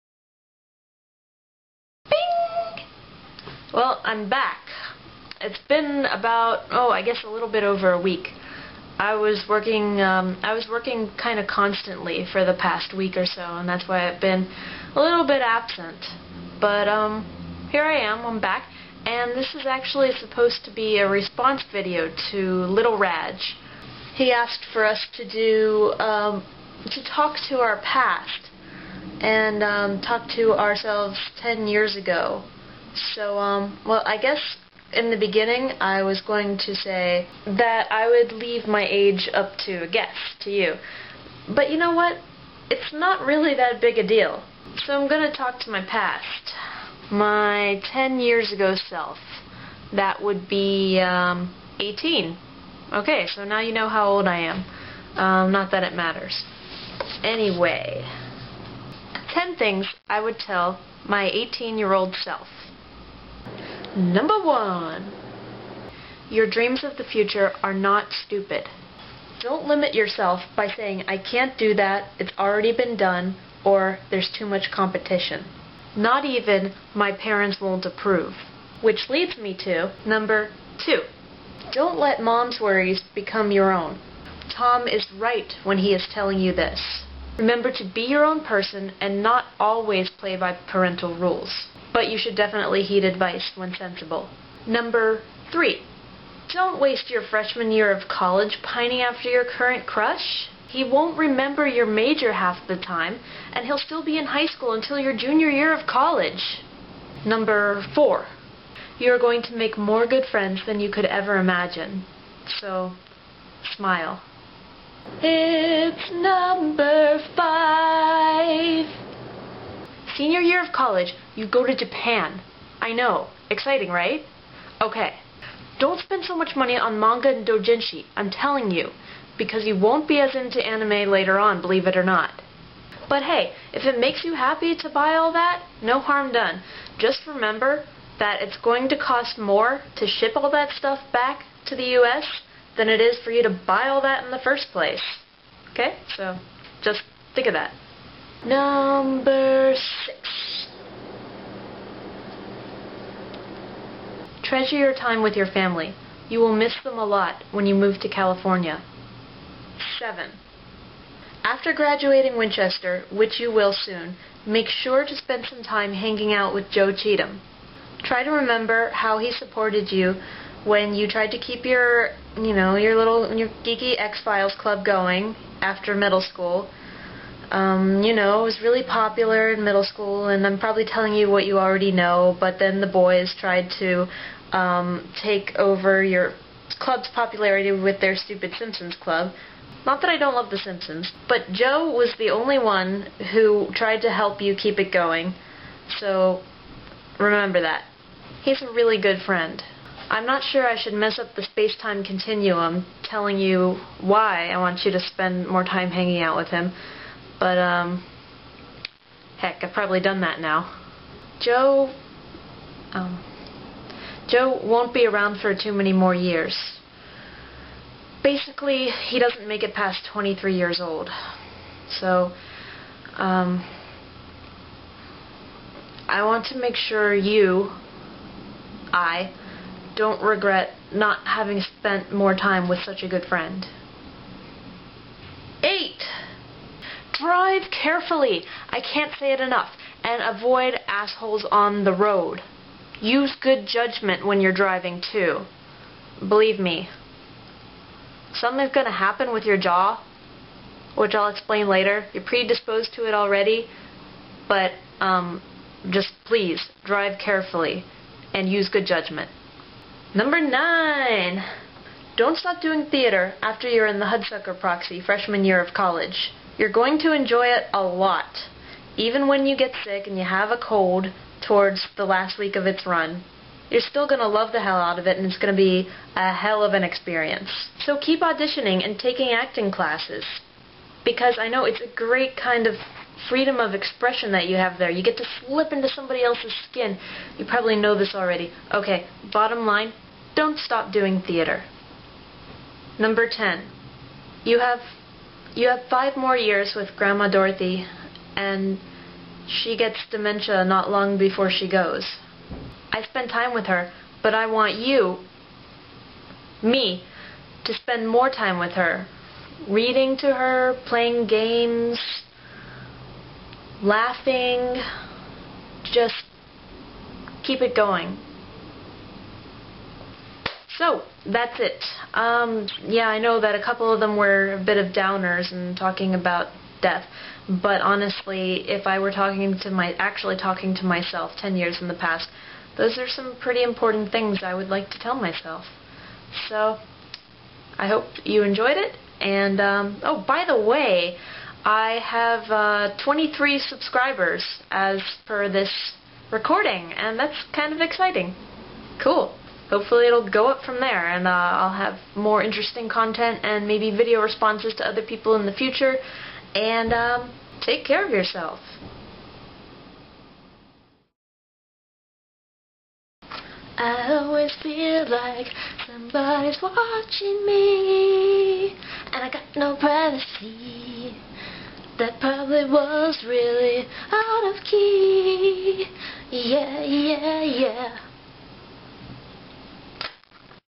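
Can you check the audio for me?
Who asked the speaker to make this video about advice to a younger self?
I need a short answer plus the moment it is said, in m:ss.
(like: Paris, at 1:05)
LittleRadge, at 0:22.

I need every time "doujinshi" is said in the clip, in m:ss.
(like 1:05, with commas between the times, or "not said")
2:07.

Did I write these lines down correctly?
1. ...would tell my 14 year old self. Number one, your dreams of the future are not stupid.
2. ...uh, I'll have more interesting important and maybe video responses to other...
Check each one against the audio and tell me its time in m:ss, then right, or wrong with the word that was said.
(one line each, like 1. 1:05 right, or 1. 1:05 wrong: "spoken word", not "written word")
1. 1:00 wrong: "18", not "14"
2. 5:51 wrong: "content", not "important".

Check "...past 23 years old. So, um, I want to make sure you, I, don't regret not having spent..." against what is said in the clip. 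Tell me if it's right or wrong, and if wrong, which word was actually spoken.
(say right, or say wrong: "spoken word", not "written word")
right.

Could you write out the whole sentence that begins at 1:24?
Tom is right when he is telling you this.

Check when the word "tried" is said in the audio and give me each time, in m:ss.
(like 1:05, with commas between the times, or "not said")
2:51, 3:03, 3:13.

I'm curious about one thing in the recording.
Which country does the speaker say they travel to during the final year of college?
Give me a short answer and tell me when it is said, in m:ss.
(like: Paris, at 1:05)
Japan, at 2:01.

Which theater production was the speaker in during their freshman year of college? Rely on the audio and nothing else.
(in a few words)
The Hudsucker Proxy.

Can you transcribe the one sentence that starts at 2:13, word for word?
But hey, if it makes you happy to buy all that, no harm done.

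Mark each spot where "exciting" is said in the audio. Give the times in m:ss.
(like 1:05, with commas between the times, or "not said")
2:03, 5:47.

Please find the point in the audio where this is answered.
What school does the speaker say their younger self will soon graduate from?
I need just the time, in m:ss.
2:42.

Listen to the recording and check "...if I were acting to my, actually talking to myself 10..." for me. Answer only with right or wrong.
wrong.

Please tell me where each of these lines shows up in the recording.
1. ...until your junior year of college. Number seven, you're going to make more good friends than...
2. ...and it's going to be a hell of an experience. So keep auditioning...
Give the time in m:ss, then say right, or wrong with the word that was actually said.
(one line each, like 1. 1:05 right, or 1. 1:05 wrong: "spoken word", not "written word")
1. 1:44 wrong: "four", not "seven"
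2. 4:35 right.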